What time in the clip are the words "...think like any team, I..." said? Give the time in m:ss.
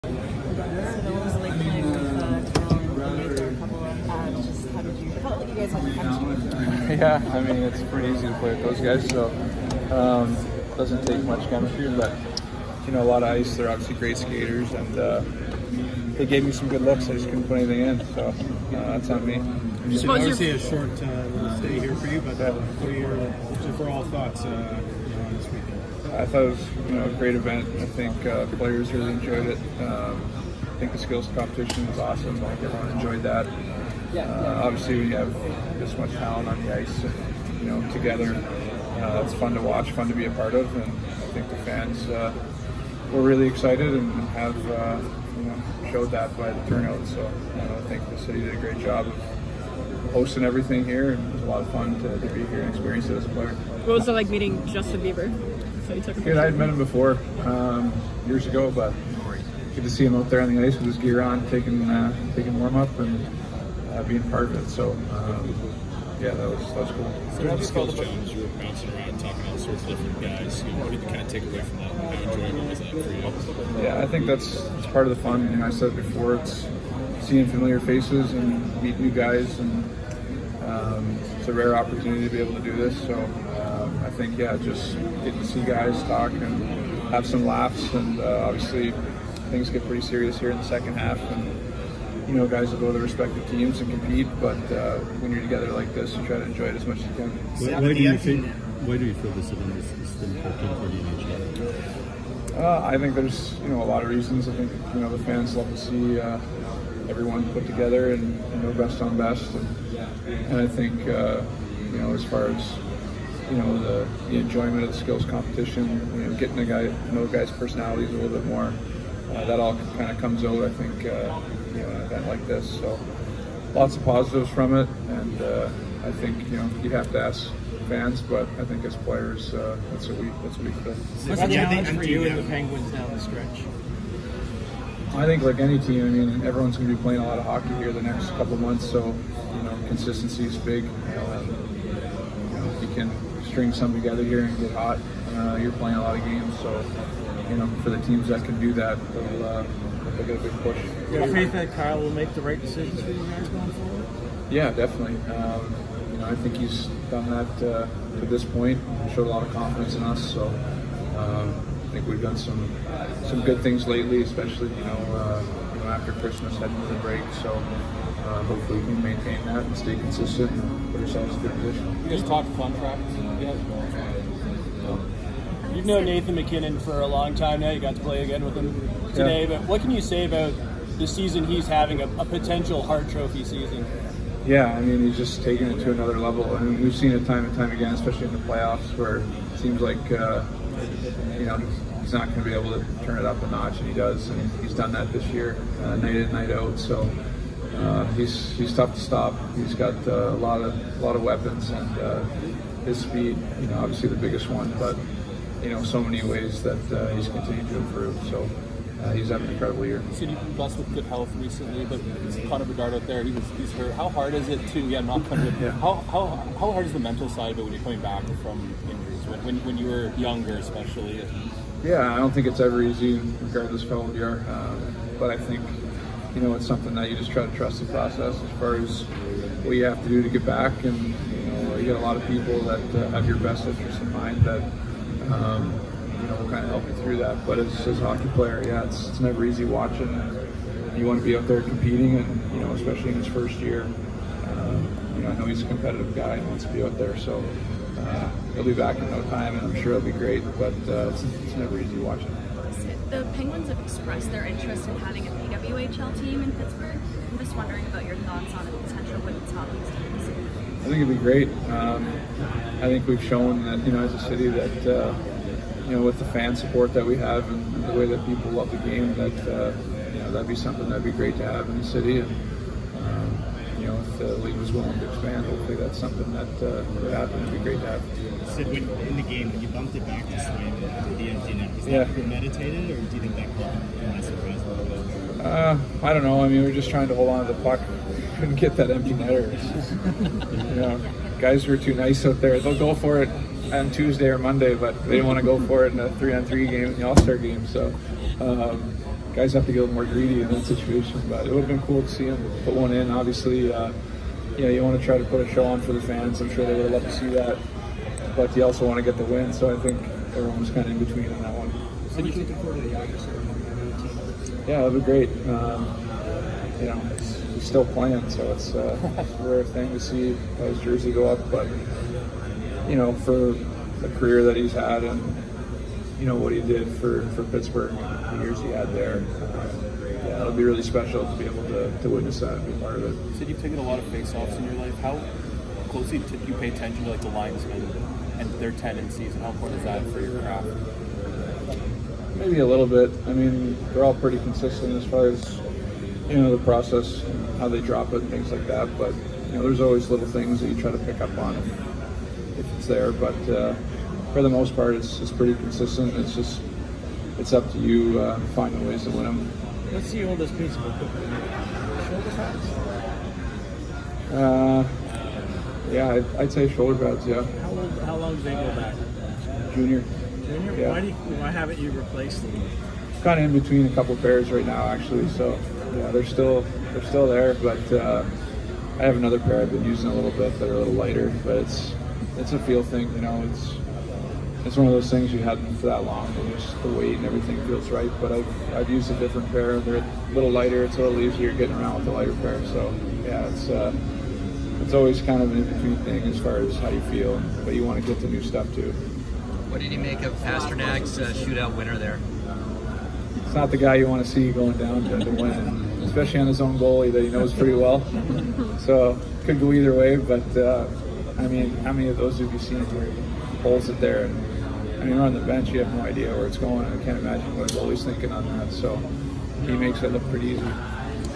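2:15.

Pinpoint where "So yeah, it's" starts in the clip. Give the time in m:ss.
6:32.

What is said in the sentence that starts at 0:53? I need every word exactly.
What was it like meeting Justin Bieber?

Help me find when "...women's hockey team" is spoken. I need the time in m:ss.
4:19.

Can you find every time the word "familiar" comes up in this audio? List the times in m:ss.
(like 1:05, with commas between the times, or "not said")
1:17.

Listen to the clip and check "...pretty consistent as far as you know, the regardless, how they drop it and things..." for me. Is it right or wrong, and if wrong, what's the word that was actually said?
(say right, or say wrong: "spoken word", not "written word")
wrong: "process", not "regardless".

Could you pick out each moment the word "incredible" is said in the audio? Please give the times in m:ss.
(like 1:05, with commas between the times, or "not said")
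3:29.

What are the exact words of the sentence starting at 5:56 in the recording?
It's just, it's up to you uh, finding ways to win them.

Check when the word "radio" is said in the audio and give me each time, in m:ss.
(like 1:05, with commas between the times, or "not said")
not said.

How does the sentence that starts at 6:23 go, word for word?
It's it's one of those things you have them for that long, and just the weight and everything feels right.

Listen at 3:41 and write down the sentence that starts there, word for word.
Yeah, I don't think it's ever easy, regardless of how old you are.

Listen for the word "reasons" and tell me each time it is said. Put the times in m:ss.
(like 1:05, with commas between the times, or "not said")
1:44.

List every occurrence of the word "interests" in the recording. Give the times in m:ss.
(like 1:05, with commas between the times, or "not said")
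3:53, 4:14.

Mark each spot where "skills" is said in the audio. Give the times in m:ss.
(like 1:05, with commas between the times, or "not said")
0:30, 1:07, 1:54.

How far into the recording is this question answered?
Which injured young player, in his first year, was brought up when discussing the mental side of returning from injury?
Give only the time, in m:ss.
3:32.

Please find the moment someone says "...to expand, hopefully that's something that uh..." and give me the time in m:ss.
4:34.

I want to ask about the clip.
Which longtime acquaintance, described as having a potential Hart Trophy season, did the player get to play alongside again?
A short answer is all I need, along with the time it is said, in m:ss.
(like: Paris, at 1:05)
Nathan MacKinnon, at 2:56.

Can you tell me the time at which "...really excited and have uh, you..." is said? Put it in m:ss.
0:43.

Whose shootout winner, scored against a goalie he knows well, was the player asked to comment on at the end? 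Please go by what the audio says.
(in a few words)
Pastrnak.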